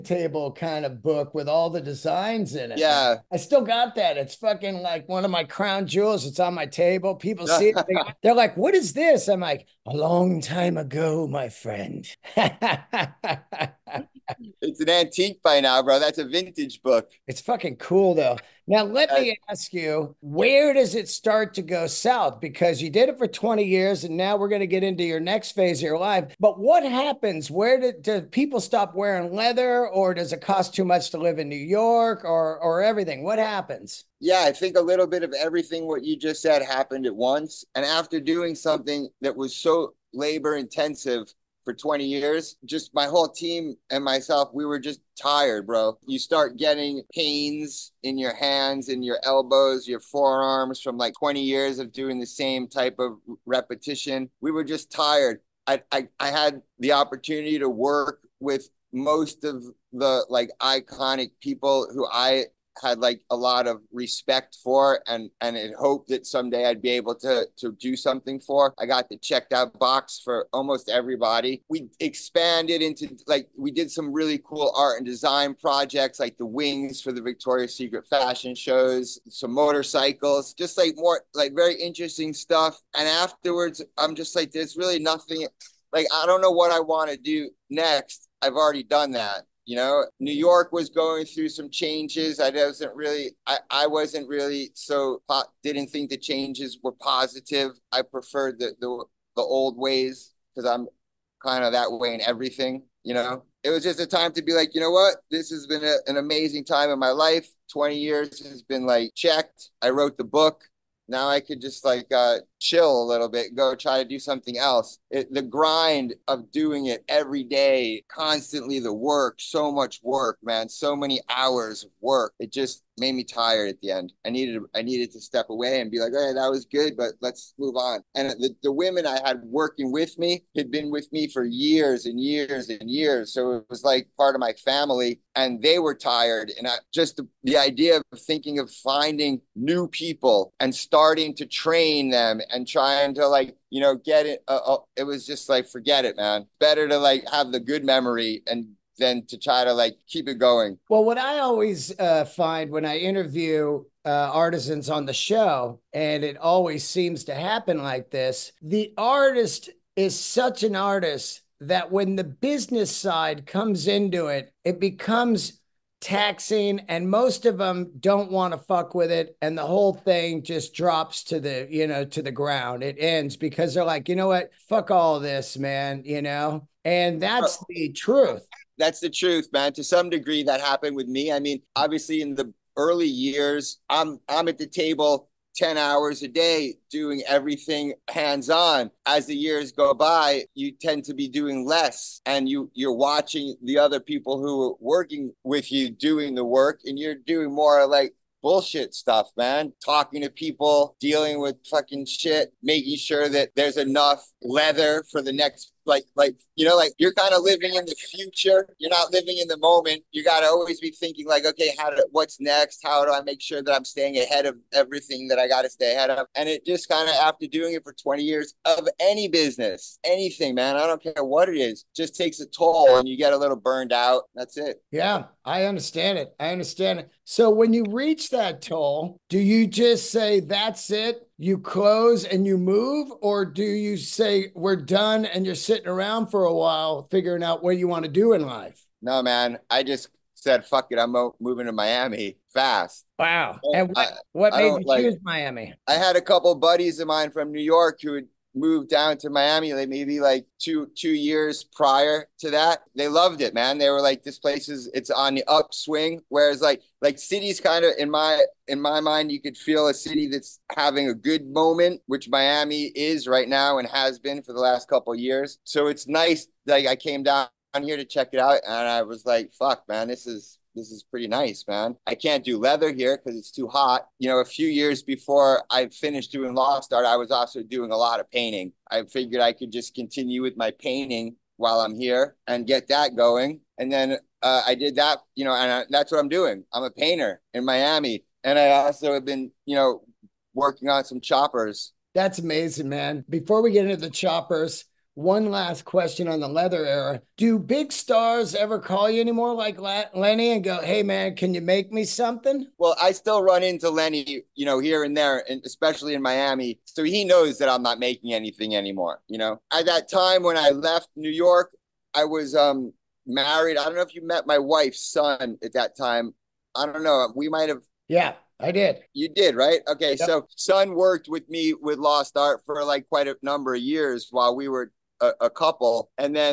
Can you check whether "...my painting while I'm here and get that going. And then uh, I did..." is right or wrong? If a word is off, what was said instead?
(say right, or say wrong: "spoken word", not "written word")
right.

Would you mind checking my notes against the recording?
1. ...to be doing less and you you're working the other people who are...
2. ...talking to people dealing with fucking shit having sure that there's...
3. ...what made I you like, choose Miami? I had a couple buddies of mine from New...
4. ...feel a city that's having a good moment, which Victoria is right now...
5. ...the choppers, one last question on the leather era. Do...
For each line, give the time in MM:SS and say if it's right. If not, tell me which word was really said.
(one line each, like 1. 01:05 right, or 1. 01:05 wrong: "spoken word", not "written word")
1. 03:11 wrong: "watching", not "working"
2. 03:19 wrong: "making", not "having"
3. 04:04 right
4. 04:19 wrong: "Miami", not "Victoria"
5. 04:53 right.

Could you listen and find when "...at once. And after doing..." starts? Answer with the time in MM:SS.
00:37.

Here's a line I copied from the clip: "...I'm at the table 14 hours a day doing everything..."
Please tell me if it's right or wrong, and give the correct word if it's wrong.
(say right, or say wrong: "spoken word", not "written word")
wrong: "10", not "14".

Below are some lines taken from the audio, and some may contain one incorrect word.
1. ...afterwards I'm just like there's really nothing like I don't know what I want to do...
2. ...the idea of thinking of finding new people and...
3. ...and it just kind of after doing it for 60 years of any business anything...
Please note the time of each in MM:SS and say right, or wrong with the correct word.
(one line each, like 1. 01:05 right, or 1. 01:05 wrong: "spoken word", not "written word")
1. 01:23 right
2. 02:17 right
3. 03:36 wrong: "20", not "60".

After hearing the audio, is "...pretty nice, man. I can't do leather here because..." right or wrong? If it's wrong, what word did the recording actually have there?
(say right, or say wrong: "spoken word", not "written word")
right.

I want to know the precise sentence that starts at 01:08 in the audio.
I got the checked out box for almost everybody.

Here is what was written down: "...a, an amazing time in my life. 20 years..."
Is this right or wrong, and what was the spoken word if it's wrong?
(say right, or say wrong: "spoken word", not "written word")
right.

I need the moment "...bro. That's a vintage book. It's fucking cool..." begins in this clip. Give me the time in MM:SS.
00:15.